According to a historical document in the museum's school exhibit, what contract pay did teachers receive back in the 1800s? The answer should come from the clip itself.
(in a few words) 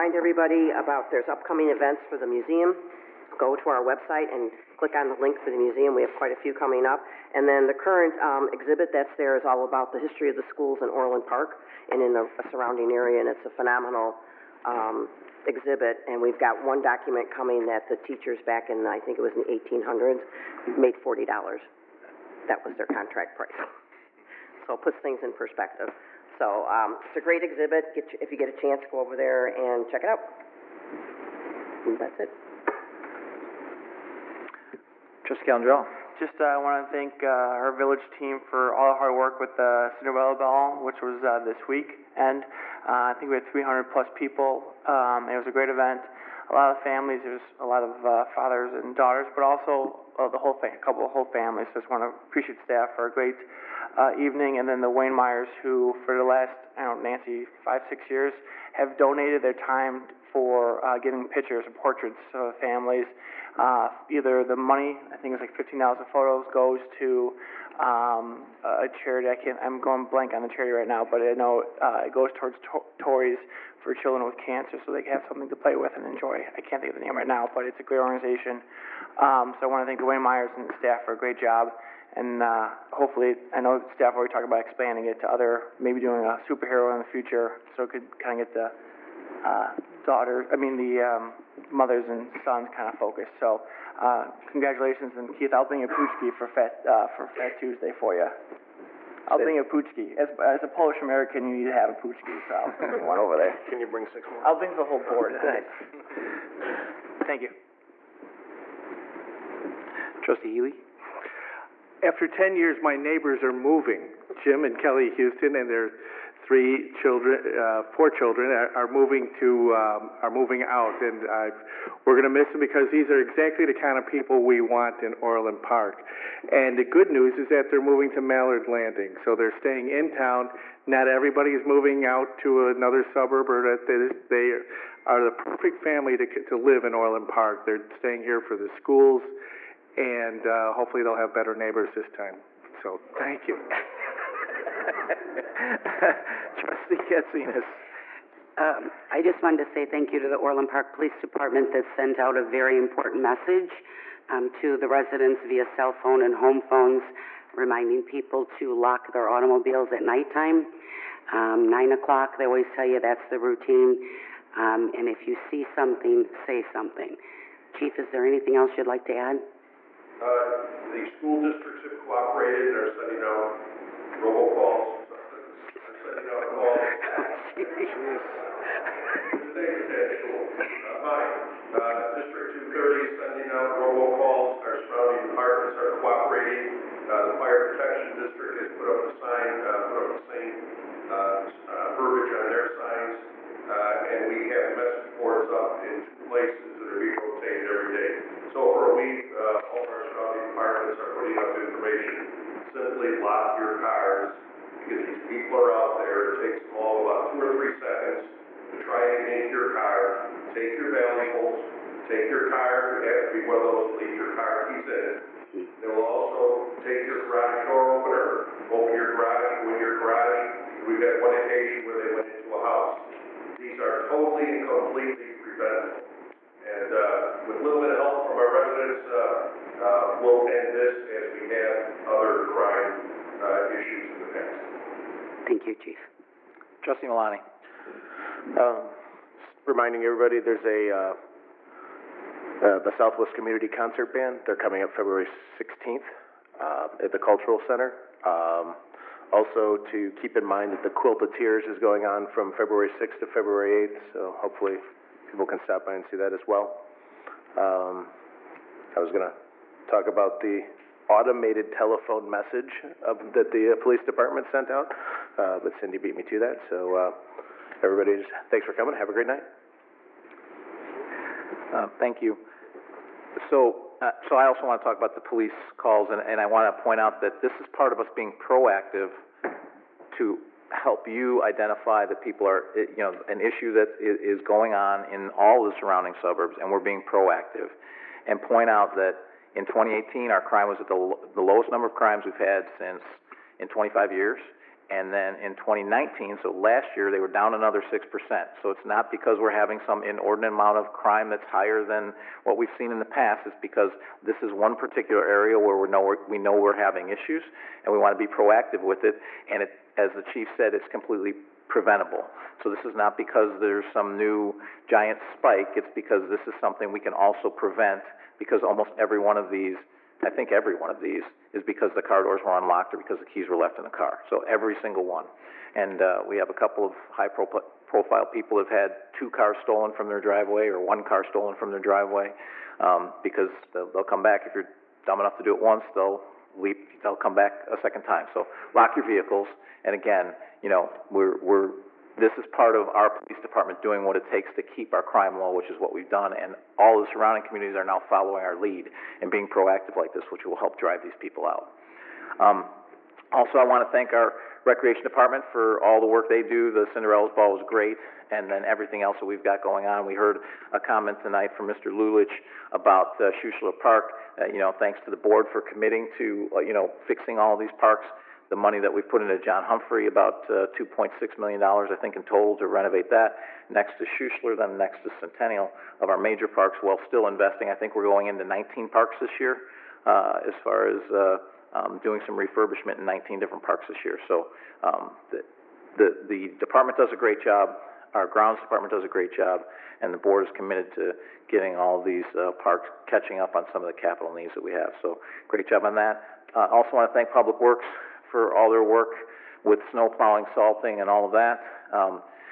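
$40.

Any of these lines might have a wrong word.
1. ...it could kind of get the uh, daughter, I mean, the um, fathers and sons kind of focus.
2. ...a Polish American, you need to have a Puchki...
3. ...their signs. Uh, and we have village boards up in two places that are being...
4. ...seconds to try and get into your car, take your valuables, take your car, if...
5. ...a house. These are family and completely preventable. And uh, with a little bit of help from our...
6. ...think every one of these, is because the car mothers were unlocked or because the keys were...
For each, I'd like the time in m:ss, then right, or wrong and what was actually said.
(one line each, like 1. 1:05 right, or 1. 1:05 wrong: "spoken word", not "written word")
1. 1:27 wrong: "mothers", not "fathers"
2. 1:40 right
3. 3:12 wrong: "message", not "village"
4. 3:27 right
5. 3:42 wrong: "totally", not "family"
6. 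5:20 wrong: "doors", not "mothers".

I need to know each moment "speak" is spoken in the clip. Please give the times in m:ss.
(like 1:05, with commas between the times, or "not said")
not said.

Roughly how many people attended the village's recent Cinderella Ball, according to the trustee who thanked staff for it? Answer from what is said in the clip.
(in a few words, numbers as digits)
300 plus.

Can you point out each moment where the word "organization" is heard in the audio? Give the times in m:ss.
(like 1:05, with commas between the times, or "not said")
1:17.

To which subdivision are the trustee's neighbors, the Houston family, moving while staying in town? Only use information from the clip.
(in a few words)
Mallard Landing.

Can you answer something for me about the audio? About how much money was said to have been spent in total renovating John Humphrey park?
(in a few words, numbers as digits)
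2.6 million dollars.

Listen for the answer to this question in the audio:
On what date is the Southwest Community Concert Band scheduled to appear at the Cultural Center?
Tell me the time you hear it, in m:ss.
4:04.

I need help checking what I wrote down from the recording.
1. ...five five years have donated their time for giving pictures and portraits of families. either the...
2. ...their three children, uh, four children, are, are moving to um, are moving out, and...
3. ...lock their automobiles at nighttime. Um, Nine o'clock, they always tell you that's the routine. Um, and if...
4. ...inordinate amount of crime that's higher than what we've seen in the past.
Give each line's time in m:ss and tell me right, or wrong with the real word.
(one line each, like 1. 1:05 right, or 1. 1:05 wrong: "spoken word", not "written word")
1. 0:57 wrong: "six", not "five"
2. 1:55 right
3. 2:38 right
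4. 5:00 right.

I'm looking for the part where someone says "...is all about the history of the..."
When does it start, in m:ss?
0:09.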